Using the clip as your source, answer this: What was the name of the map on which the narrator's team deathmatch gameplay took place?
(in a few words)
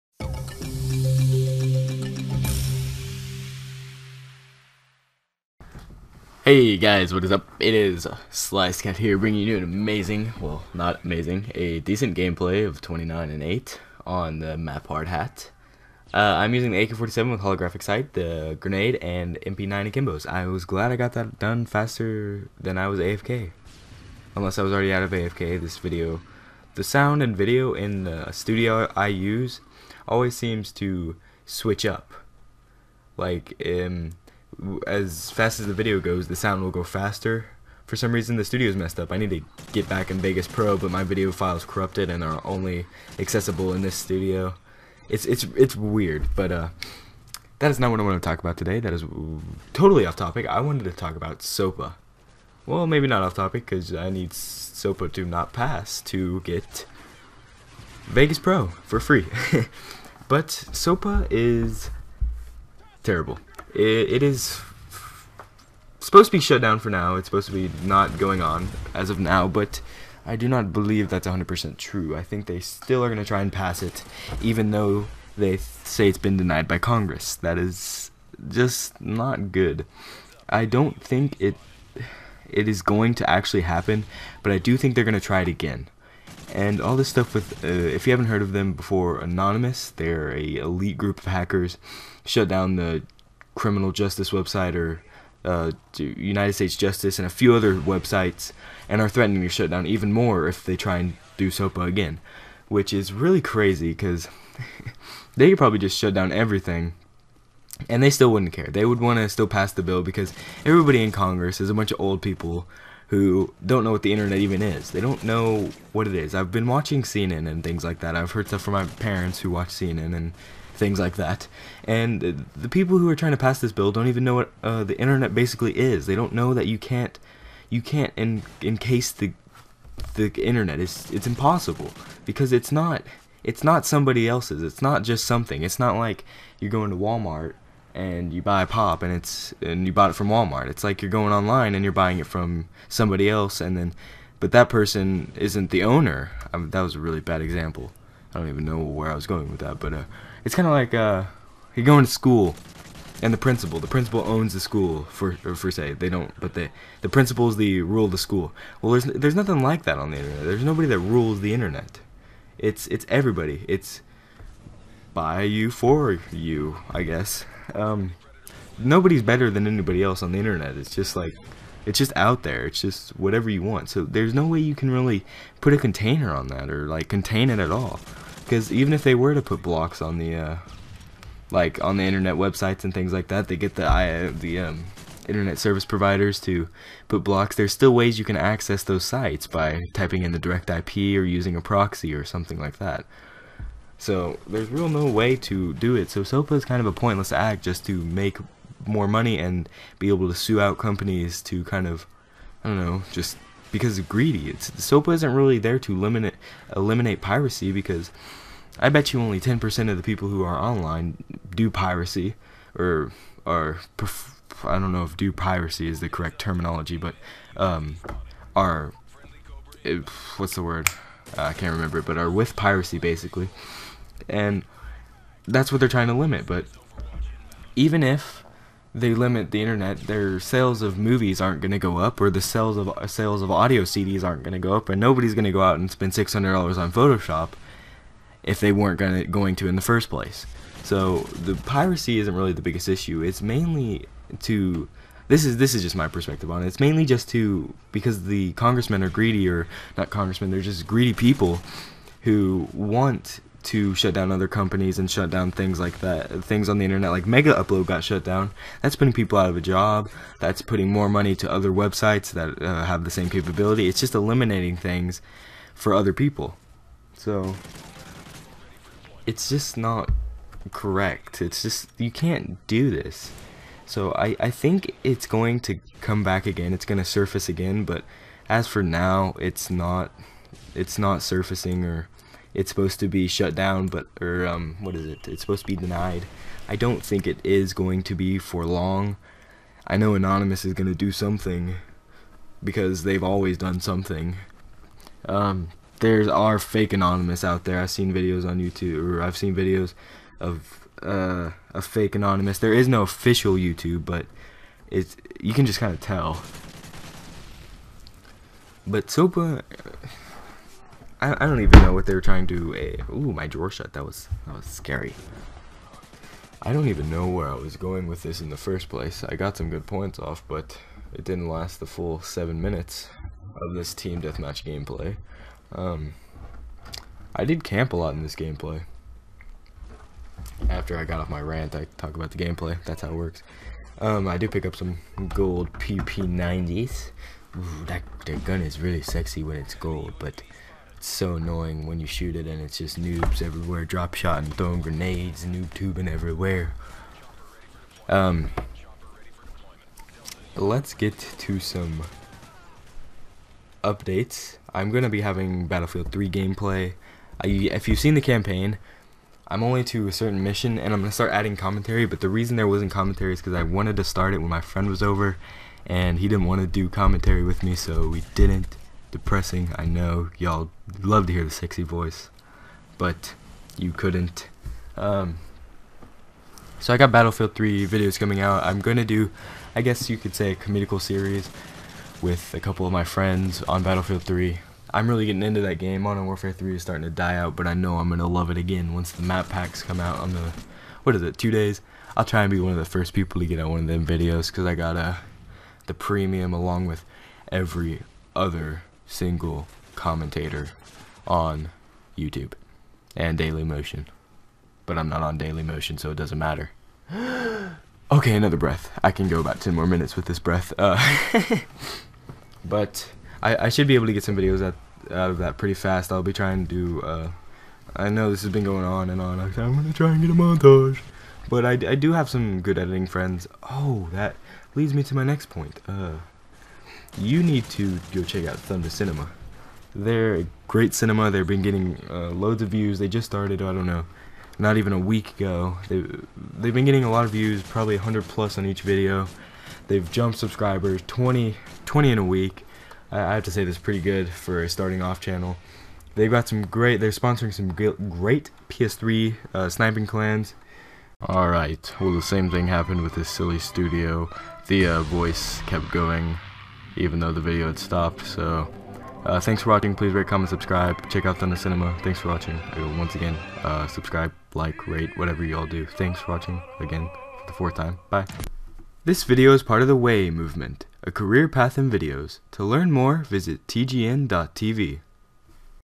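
Hard Hat.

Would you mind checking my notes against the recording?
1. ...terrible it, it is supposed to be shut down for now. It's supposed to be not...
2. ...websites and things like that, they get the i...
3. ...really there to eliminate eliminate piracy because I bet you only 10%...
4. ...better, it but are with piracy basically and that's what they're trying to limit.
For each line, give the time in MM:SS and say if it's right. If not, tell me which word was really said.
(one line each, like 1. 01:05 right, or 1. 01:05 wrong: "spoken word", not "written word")
1. 01:03 right
2. 03:02 right
3. 03:25 right
4. 03:41 wrong: "remember", not "better".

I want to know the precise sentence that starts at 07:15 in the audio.
They, they've been getting a lot of views, probably 100 plus on each video.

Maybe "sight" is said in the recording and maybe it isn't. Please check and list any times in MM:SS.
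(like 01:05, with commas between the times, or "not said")
00:17.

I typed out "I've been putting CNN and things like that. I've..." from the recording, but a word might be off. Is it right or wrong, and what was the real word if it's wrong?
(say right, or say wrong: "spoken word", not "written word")
wrong: "watching", not "putting".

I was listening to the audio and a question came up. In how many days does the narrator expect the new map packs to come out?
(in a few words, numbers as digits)
2.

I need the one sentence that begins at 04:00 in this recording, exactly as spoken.
So the piracy isn't really the biggest issue.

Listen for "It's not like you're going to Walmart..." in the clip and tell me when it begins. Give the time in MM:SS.
02:15.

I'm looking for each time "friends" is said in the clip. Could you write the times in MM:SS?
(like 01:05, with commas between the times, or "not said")
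06:04, 06:23, 07:03.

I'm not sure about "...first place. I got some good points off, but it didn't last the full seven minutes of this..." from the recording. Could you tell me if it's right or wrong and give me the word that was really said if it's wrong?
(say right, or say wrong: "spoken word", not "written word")
right.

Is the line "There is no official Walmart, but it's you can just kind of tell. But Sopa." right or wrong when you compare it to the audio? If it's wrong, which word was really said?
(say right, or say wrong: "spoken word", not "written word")
wrong: "YouTube", not "Walmart".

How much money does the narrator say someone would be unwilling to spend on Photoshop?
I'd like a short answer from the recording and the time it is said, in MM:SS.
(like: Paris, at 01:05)
$600, at 03:56.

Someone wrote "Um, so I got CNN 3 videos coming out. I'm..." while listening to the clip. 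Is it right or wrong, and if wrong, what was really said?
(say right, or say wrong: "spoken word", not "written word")
wrong: "Battlefield", not "CNN".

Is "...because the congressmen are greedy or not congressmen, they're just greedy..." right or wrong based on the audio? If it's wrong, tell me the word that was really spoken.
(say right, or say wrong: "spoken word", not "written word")
right.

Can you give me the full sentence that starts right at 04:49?
I know Anonymous is going to do something because they've always done something.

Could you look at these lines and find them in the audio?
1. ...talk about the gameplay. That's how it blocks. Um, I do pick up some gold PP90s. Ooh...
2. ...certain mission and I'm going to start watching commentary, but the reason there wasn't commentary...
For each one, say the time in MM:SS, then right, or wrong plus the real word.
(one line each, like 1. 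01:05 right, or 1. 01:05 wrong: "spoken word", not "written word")
1. 05:31 wrong: "works", not "blocks"
2. 06:00 wrong: "adding", not "watching".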